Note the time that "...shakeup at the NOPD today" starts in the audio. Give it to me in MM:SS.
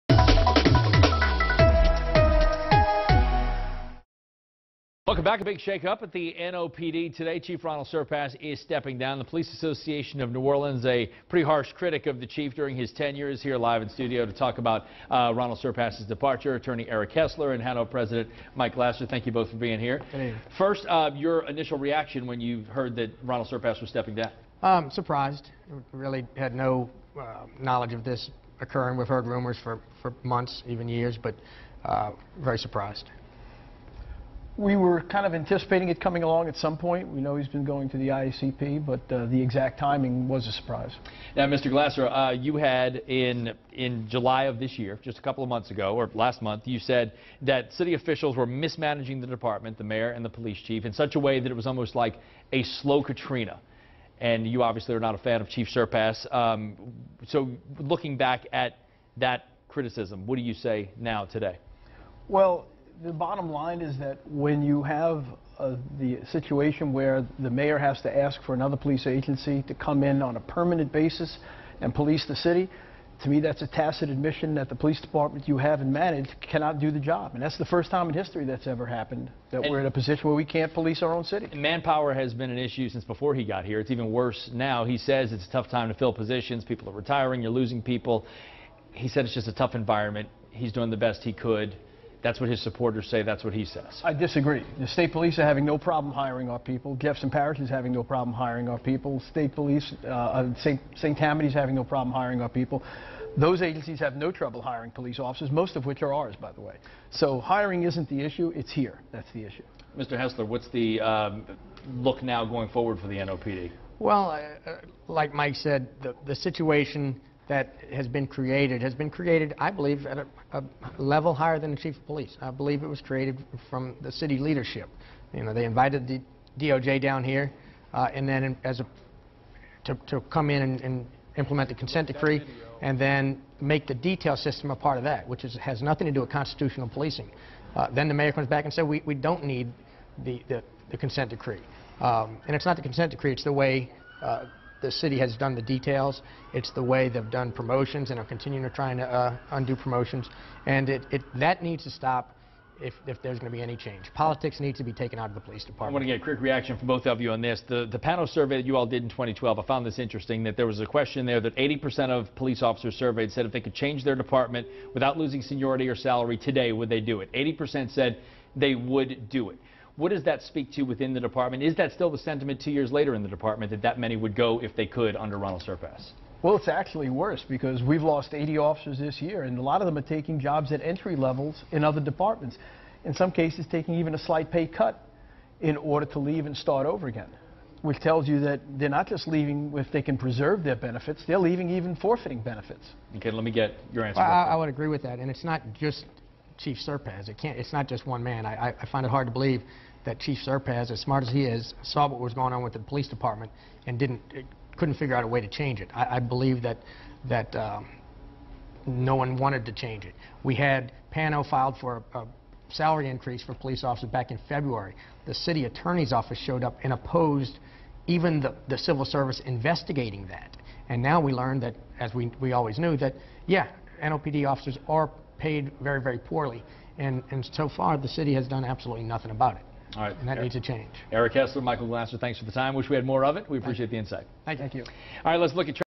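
00:05.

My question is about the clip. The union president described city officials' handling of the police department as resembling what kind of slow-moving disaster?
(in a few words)
a slow Katrina.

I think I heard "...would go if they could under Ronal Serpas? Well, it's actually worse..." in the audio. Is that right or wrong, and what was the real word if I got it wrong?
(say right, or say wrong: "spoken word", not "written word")
right.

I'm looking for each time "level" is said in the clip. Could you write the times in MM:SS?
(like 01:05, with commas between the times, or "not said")
02:00, 03:01.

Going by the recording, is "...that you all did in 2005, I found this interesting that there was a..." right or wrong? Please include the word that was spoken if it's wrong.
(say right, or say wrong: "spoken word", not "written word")
wrong: "2012", not "2005".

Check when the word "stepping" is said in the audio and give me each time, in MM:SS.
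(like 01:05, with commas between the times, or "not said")
00:08, 00:23.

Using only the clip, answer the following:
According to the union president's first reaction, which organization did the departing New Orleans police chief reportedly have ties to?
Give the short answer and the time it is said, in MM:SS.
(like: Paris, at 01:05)
IACP, at 00:38.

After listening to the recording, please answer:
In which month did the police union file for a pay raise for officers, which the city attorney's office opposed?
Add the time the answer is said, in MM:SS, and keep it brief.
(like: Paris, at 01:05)
February, at 03:34.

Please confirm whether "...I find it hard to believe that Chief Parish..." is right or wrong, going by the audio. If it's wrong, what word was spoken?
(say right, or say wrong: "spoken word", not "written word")
wrong: "Serpas", not "Parish".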